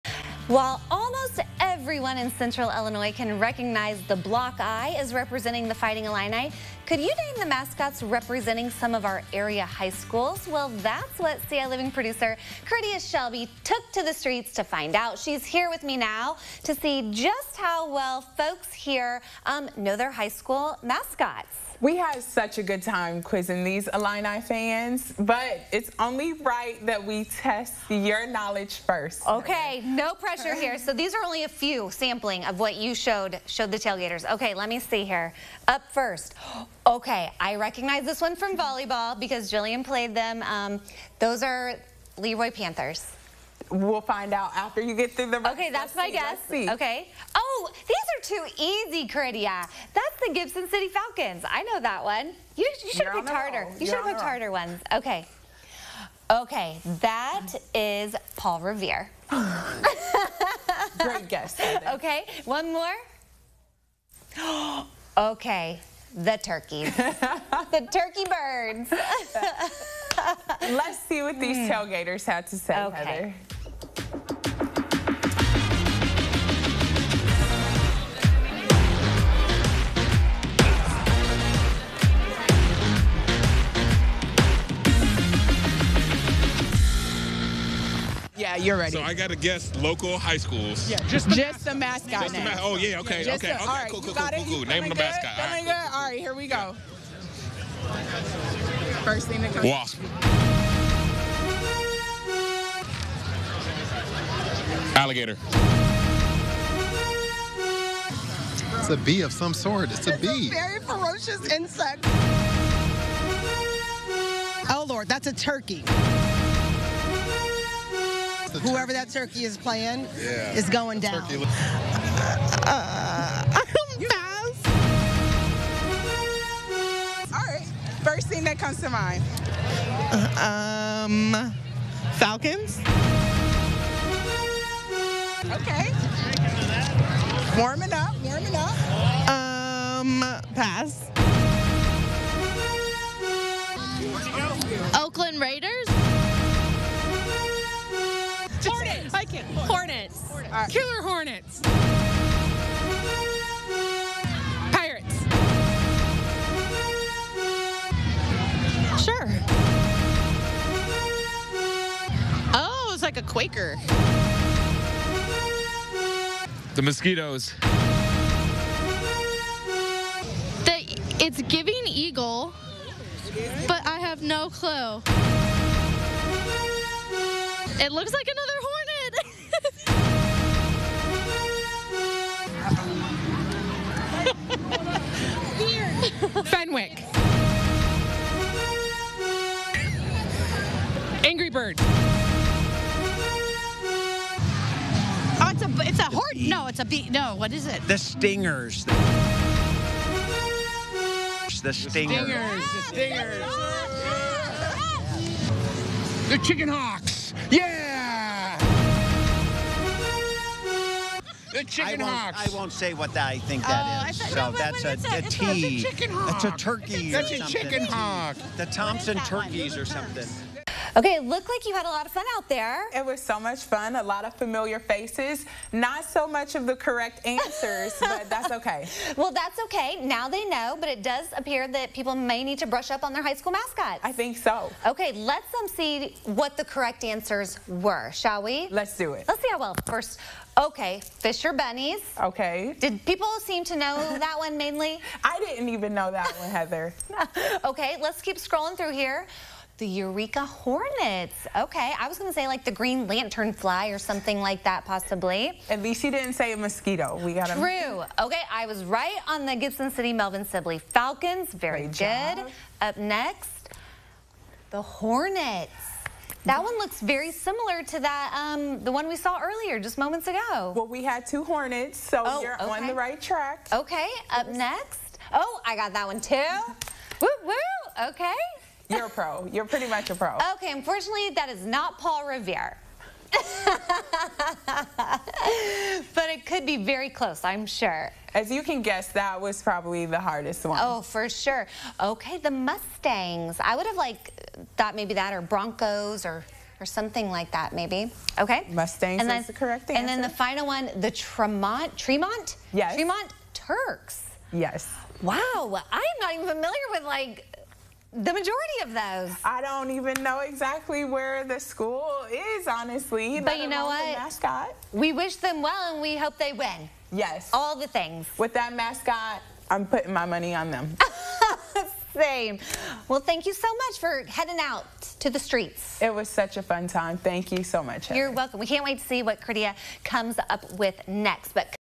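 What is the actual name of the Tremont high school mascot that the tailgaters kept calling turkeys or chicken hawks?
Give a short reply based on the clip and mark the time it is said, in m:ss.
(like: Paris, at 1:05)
Tremont Turks, at 5:02.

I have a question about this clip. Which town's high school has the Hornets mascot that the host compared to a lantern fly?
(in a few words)
Eureka.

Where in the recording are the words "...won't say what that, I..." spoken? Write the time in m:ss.
3:32.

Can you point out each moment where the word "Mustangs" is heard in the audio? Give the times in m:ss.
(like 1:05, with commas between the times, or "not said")
4:52, 4:58.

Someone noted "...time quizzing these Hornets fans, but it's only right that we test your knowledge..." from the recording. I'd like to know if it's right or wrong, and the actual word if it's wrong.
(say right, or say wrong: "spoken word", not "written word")
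wrong: "Illini", not "Hornets".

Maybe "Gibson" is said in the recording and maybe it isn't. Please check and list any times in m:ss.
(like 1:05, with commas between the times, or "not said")
0:50, 4:19.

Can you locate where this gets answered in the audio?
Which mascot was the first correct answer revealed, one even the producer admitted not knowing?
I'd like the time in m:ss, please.
4:01.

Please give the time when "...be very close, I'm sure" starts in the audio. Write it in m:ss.
4:46.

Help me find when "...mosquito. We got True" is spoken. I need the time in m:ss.
4:16.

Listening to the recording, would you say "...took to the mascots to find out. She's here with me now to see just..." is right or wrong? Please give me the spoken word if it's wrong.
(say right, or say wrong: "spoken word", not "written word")
wrong: "streets", not "mascots".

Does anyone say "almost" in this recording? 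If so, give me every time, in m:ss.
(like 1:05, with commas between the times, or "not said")
0:00.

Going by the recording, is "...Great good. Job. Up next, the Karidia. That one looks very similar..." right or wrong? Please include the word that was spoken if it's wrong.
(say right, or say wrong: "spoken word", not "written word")
wrong: "Hornets", not "Karidia".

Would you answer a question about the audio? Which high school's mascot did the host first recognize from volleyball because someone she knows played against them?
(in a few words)
LeRoy Panthers.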